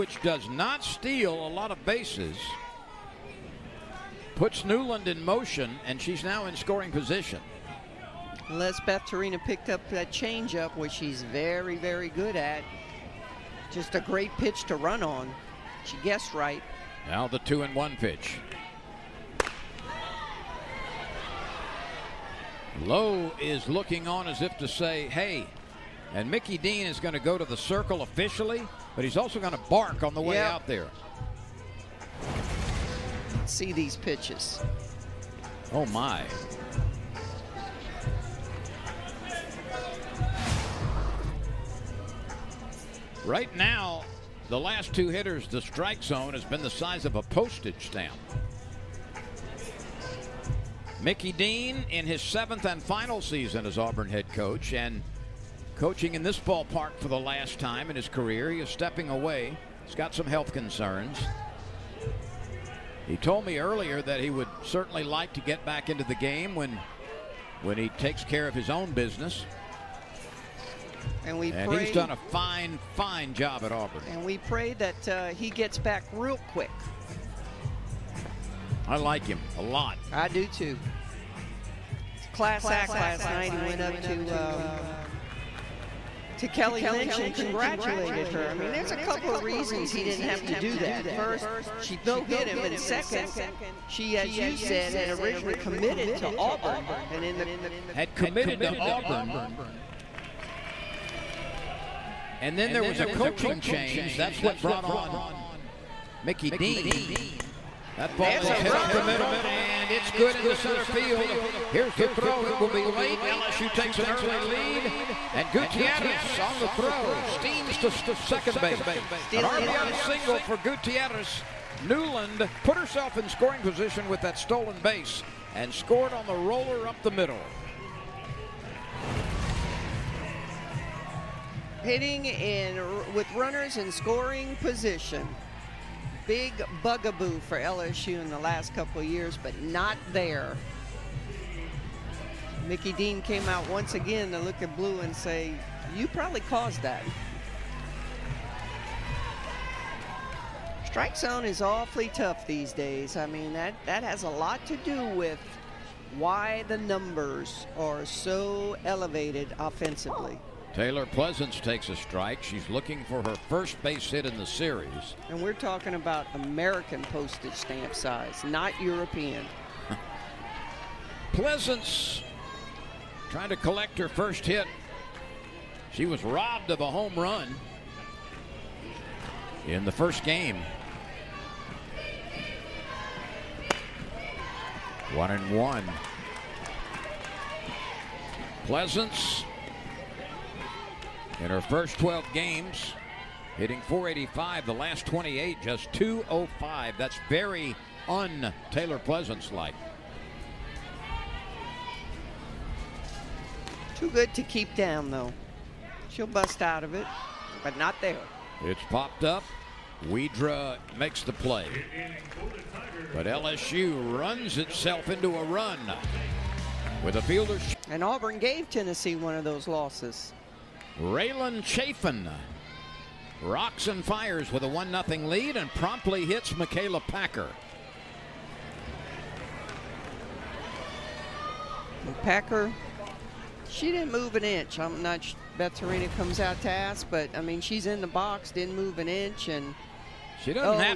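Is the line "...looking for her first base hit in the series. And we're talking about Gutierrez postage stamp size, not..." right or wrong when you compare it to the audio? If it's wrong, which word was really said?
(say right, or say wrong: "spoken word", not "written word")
wrong: "American", not "Gutierrez".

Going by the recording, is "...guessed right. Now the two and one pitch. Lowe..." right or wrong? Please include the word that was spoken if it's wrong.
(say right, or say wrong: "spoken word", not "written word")
right.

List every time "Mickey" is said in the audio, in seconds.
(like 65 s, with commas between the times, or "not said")
26 s, 51 s, 106 s, 142 s.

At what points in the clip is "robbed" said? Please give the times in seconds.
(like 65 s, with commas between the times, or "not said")
176 s.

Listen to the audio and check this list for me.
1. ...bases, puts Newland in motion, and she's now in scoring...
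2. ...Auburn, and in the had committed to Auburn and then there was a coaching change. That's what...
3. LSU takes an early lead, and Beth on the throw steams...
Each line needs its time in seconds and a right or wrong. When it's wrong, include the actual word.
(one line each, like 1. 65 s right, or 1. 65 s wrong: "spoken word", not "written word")
1. 1 s right
2. 96 s right
3. 113 s wrong: "Gutierrez", not "Beth".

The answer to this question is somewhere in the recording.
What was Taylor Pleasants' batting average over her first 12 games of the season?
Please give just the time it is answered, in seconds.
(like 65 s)
193 s.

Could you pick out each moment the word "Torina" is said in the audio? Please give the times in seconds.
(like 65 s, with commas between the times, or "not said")
9 s, 235 s.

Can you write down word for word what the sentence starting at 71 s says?
And we and pray, he's done a fine, fine job at Auburn.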